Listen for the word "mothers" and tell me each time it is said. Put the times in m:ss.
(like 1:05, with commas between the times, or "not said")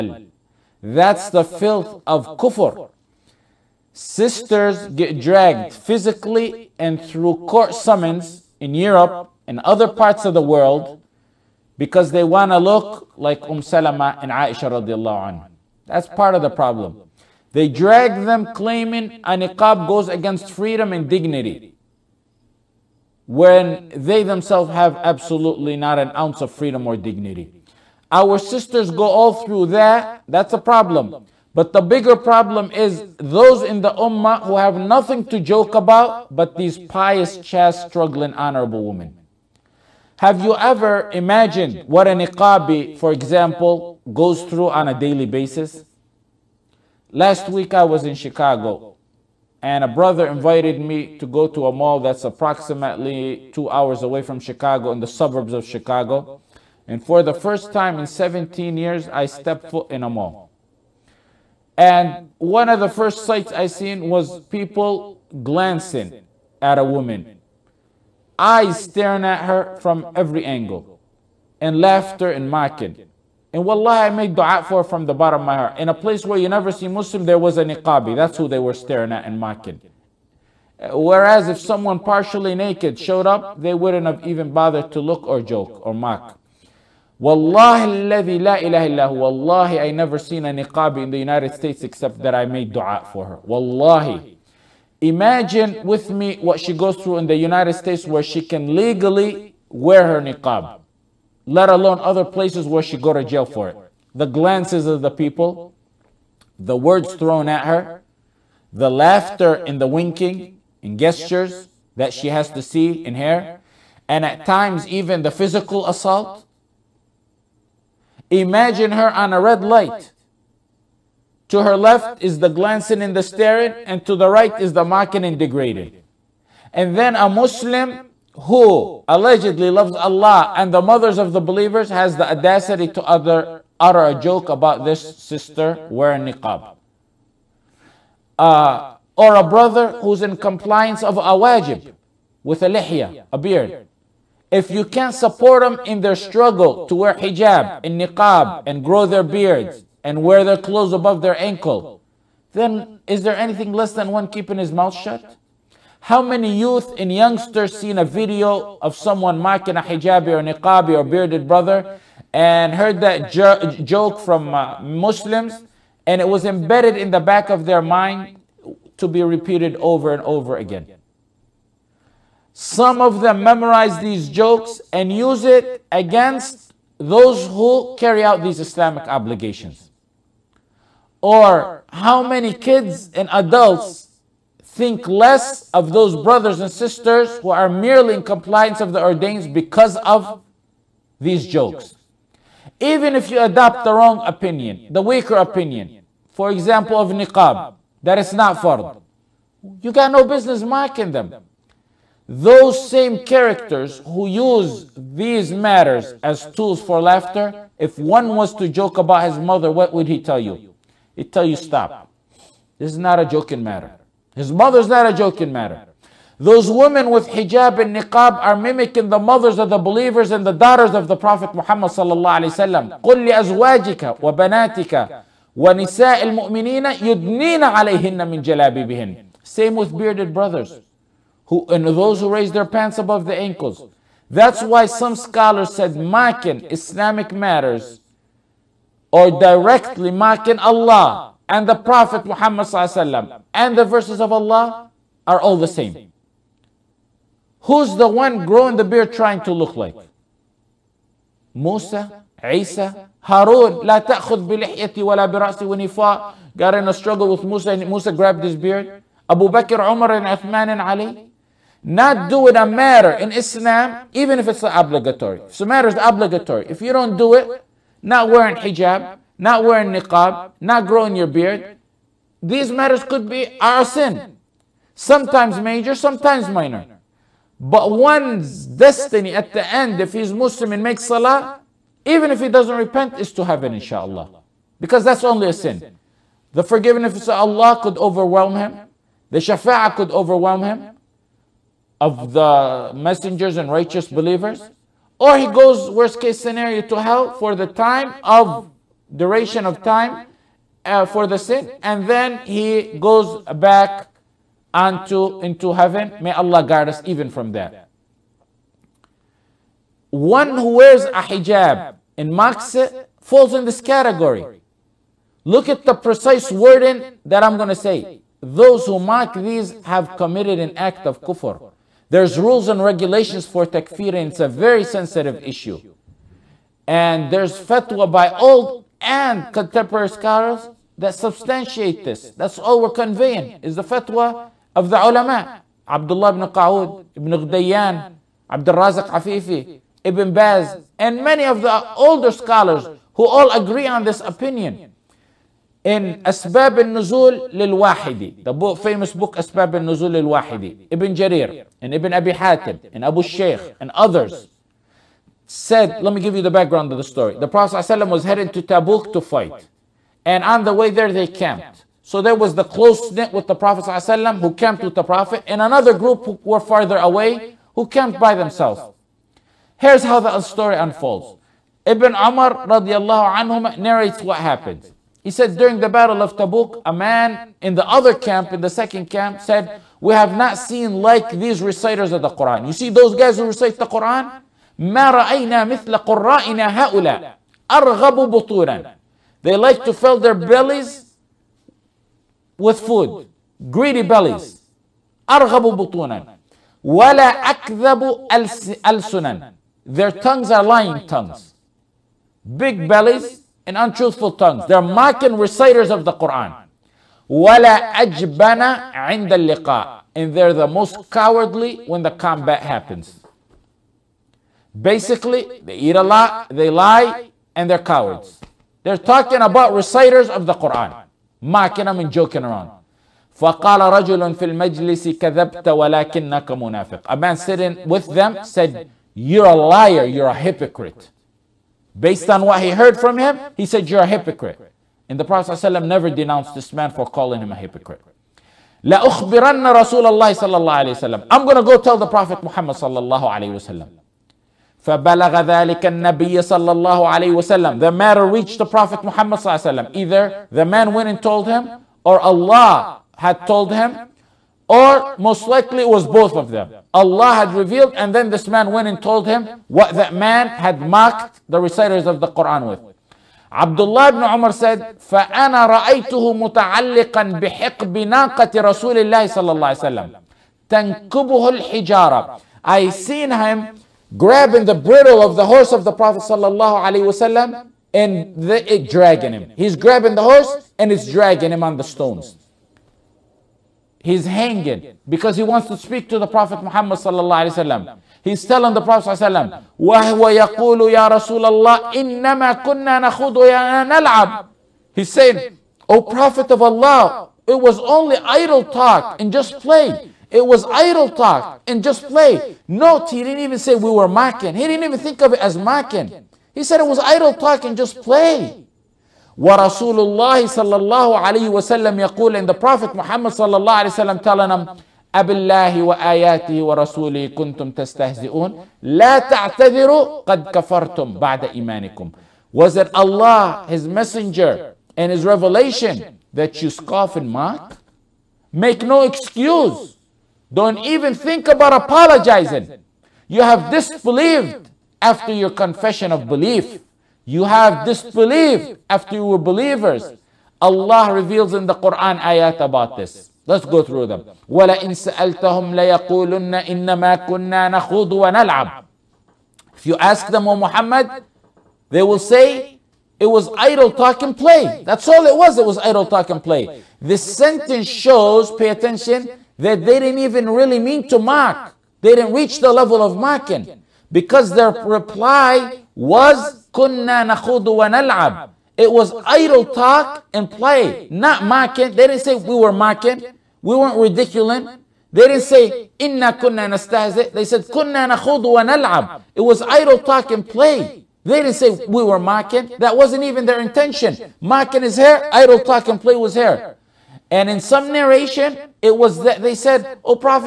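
2:10, 3:29, 3:34, 3:39.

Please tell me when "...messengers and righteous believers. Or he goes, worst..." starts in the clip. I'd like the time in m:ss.
4:52.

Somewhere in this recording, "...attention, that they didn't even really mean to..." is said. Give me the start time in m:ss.
9:18.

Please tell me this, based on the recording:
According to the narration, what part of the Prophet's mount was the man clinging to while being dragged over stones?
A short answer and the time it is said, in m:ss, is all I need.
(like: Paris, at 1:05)
The bridle, at 7:54.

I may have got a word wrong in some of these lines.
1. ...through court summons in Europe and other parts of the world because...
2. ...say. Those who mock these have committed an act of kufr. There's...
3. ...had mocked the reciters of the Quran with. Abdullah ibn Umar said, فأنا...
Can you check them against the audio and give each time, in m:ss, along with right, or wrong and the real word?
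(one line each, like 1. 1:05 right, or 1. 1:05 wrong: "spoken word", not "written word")
1. 0:07 right
2. 5:17 right
3. 7:40 right.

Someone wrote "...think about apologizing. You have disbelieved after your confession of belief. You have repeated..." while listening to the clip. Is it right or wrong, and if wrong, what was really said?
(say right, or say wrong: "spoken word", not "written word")
wrong: "disbelieved", not "repeated".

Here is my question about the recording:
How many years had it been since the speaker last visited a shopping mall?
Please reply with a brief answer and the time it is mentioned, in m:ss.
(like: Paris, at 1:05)
17, at 0:58.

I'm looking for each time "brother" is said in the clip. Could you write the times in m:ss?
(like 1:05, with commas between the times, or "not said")
0:49, 2:19, 2:41, 3:06, 3:50.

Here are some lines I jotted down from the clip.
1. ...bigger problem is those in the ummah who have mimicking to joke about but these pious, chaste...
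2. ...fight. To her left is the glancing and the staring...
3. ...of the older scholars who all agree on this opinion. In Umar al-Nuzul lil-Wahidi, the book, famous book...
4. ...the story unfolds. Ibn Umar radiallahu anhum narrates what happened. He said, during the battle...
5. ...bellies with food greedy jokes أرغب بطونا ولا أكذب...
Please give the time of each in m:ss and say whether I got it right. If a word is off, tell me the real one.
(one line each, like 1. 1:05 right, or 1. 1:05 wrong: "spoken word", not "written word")
1. 0:31 wrong: "nothing", not "mimicking"
2. 1:59 wrong: "light", not "fight"
3. 5:41 wrong: "Asbab", not "Umar"
4. 6:10 right
5. 6:30 wrong: "bellies", not "jokes".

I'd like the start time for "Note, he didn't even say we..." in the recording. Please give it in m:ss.
8:22.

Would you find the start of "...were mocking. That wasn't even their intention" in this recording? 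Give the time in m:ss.
9:42.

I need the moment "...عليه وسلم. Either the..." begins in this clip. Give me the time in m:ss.
7:29.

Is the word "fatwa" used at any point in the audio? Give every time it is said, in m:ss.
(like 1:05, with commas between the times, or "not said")
5:27, 5:33.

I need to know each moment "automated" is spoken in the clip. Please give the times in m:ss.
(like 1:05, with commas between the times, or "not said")
not said.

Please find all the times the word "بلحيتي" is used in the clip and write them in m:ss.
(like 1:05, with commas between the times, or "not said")
4:14.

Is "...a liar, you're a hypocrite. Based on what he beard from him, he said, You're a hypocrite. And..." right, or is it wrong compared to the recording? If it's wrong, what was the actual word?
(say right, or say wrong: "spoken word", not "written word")
wrong: "heard", not "beard".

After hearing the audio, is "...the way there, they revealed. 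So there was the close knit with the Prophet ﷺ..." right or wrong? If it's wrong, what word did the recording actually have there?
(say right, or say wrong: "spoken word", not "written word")
wrong: "camped", not "revealed".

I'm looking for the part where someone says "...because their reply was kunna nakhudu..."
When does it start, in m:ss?
9:24.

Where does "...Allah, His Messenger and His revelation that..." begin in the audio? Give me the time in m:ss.
8:42.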